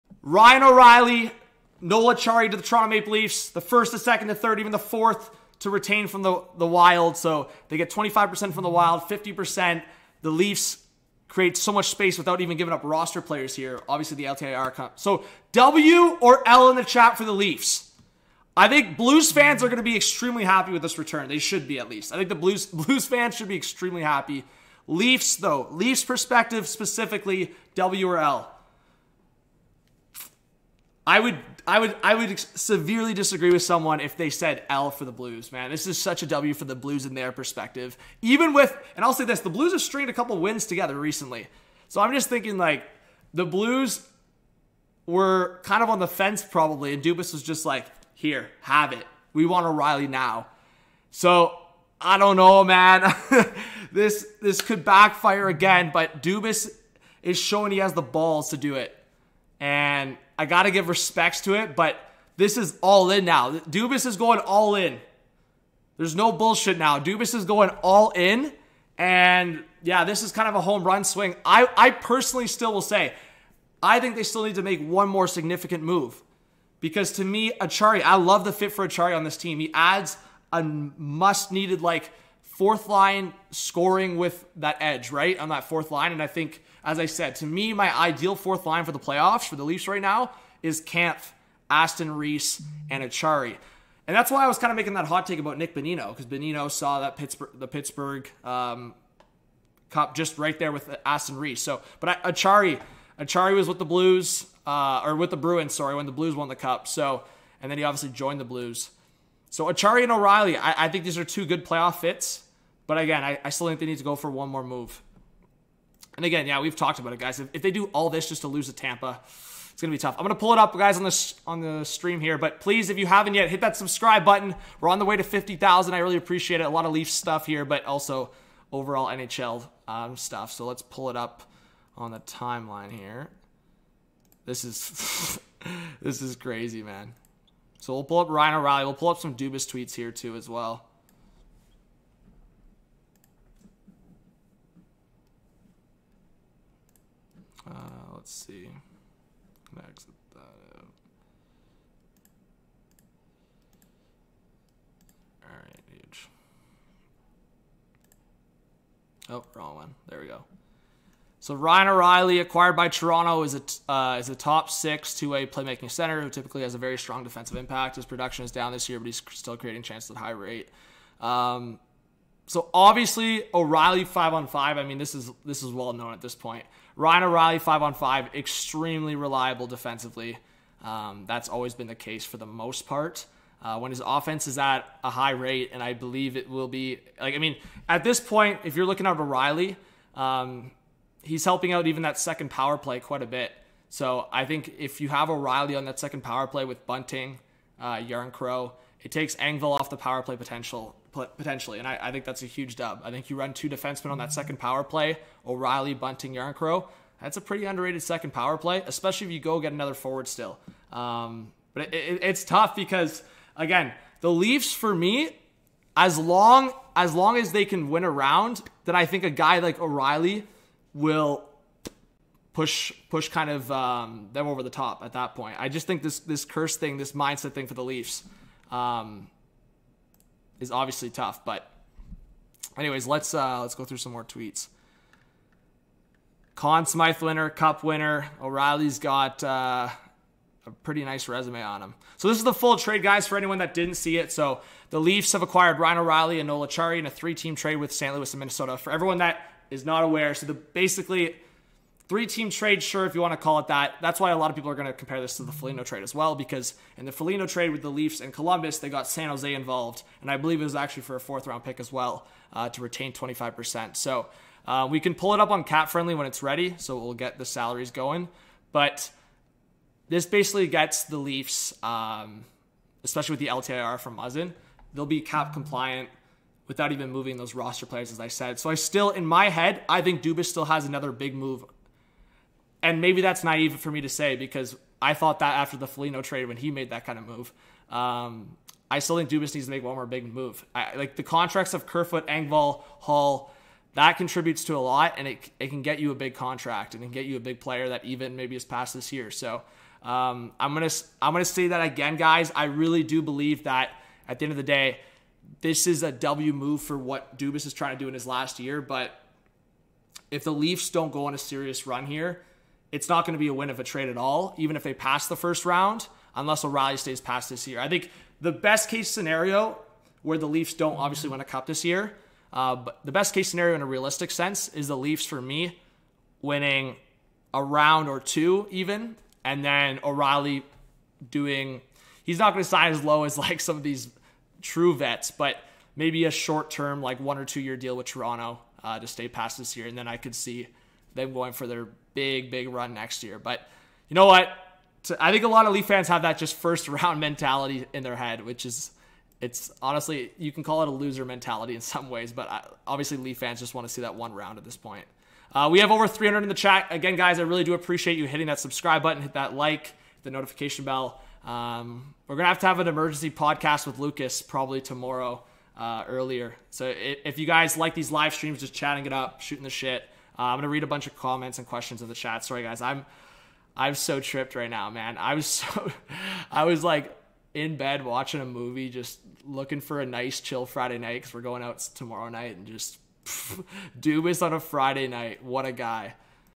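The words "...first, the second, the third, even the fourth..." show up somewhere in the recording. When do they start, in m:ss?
0:03.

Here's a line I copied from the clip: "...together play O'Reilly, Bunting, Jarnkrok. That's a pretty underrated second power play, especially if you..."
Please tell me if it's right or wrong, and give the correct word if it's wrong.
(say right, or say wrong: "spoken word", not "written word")
wrong: "power", not "together".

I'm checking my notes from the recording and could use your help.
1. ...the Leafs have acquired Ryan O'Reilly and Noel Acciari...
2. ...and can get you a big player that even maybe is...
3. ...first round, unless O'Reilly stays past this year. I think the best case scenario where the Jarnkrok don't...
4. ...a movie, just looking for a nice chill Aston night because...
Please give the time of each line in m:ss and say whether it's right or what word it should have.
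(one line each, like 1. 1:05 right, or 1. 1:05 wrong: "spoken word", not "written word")
1. 4:04 right
2. 4:56 right
3. 5:15 wrong: "Leafs", not "Jarnkrok"
4. 6:18 wrong: "Friday", not "Aston".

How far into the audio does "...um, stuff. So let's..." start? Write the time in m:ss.
2:09.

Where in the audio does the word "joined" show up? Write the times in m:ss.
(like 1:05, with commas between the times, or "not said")
1:48.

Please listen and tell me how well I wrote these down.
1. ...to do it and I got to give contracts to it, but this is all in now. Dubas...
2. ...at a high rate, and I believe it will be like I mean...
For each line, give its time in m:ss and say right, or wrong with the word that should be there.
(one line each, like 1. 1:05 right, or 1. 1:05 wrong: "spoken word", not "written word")
1. 0:58 wrong: "respects", not "contracts"
2. 3:04 right.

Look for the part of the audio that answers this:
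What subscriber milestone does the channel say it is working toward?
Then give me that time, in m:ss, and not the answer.
2:05.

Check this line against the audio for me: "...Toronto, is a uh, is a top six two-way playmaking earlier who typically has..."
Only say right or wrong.
wrong.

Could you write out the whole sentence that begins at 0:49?
We want O'Reilly now." So I don't know, man.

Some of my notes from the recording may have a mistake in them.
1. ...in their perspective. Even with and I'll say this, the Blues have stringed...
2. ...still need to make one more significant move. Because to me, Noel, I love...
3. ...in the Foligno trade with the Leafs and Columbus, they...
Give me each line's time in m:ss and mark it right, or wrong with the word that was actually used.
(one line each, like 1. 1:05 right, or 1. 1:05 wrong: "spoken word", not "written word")
1. 0:37 right
2. 1:14 wrong: "Acciari", not "Noel"
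3. 4:16 right.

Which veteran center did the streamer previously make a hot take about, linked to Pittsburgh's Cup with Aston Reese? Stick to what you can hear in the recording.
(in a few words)
Nick Bonino.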